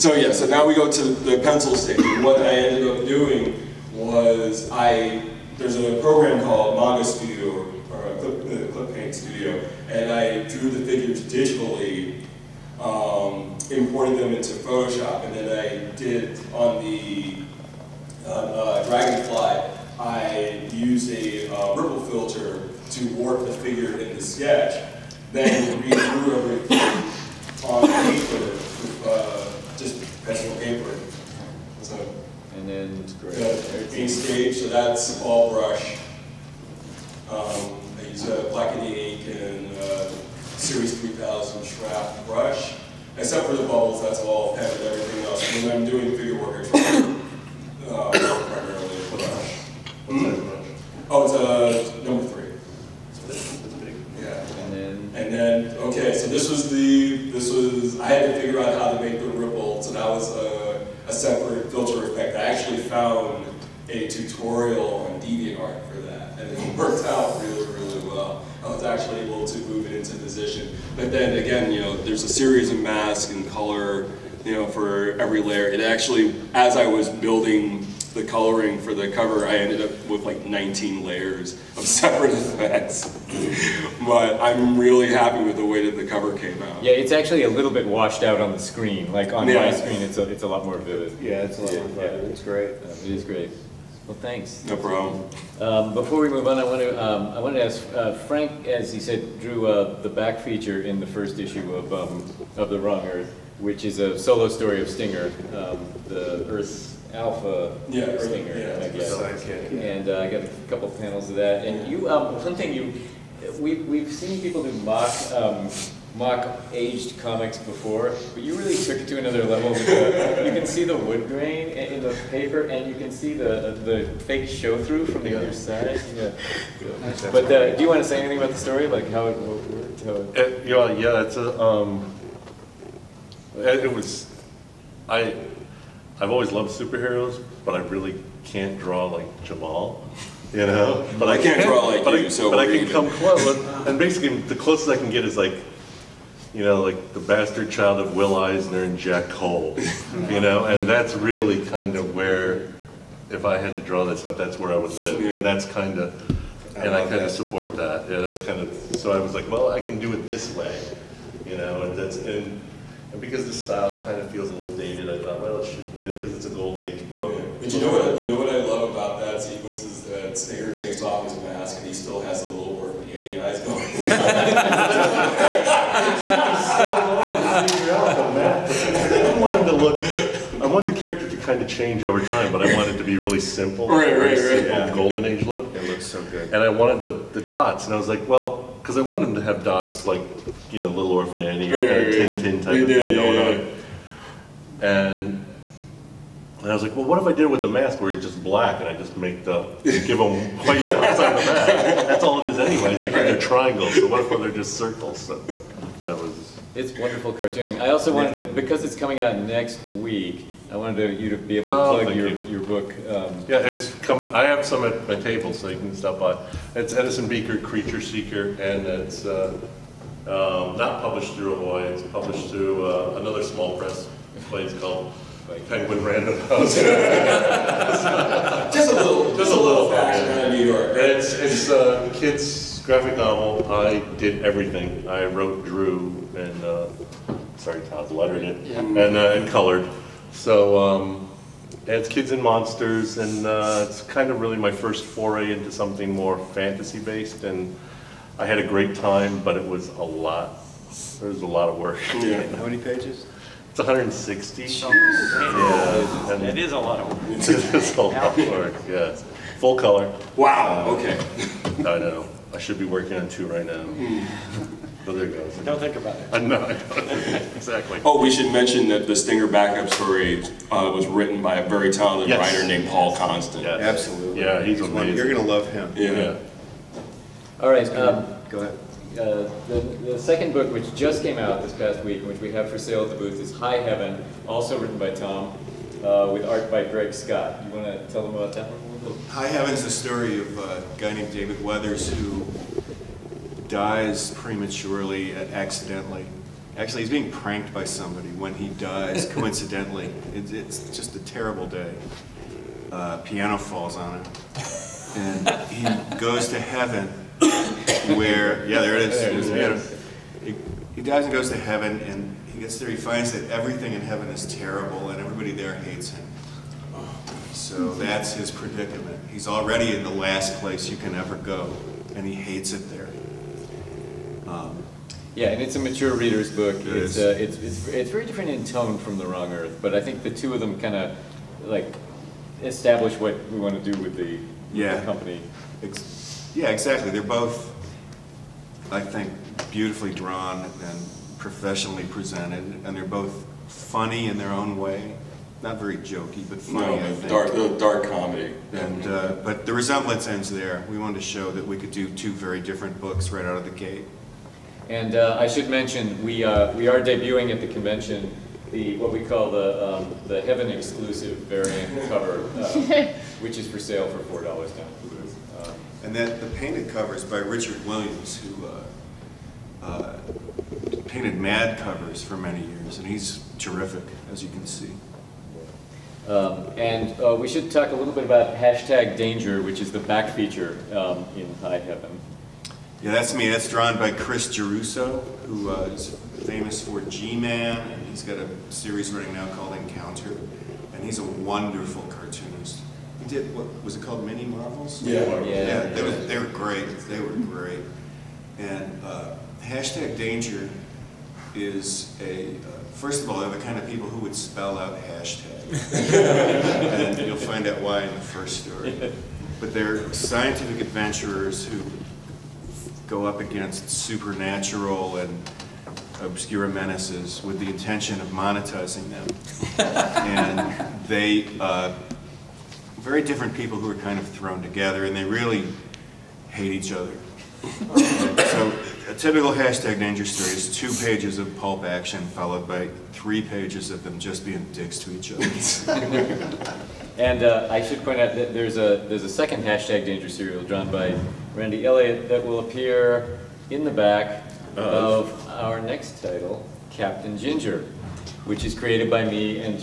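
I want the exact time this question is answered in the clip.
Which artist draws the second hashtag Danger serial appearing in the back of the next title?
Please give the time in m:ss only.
7:21.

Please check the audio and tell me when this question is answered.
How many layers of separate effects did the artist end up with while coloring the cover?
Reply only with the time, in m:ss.
1:20.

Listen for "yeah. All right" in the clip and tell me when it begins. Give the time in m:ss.
4:36.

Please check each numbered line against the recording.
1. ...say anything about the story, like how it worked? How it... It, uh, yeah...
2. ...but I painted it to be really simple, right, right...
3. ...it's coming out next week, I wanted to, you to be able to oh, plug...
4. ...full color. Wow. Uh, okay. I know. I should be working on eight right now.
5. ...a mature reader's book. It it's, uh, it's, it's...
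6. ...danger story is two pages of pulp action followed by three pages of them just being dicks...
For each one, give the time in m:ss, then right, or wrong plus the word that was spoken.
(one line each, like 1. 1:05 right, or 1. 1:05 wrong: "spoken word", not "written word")
1. 2:08 right
2. 3:02 wrong: "wanted", not "painted"
3. 3:28 right
4. 4:19 wrong: "two", not "eight"
5. 5:25 right
6. 7:09 right.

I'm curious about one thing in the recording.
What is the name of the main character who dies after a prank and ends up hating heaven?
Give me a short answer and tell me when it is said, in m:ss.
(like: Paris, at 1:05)
David Weathers, at 4:51.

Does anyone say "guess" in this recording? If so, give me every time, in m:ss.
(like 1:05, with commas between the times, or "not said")
1:48.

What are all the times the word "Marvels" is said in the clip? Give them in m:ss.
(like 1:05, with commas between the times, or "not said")
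6:34.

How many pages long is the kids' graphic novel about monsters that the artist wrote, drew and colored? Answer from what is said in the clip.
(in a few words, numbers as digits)
160.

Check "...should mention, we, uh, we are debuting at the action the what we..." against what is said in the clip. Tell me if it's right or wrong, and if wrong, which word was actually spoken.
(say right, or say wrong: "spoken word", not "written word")
wrong: "convention", not "action".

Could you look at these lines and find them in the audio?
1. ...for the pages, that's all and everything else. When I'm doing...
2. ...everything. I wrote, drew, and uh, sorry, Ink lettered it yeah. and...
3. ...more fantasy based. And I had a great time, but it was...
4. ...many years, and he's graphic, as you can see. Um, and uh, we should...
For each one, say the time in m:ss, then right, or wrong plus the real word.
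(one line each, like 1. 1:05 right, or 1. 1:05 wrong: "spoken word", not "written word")
1. 0:43 wrong: "bubbles", not "pages"
2. 3:54 wrong: "Todd", not "Ink"
3. 4:06 right
4. 6:12 wrong: "terrific", not "graphic".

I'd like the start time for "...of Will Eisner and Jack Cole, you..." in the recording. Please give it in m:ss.
2:27.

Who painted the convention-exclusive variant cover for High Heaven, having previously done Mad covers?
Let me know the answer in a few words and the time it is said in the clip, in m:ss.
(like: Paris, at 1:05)
Richard Williams, at 6:07.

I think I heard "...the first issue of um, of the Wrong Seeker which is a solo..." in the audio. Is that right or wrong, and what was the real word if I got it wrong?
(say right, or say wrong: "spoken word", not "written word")
wrong: "Earth", not "Seeker".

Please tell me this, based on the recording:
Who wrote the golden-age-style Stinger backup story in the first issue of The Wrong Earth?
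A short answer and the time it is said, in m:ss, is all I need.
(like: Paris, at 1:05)
Paul Constant, at 4:32.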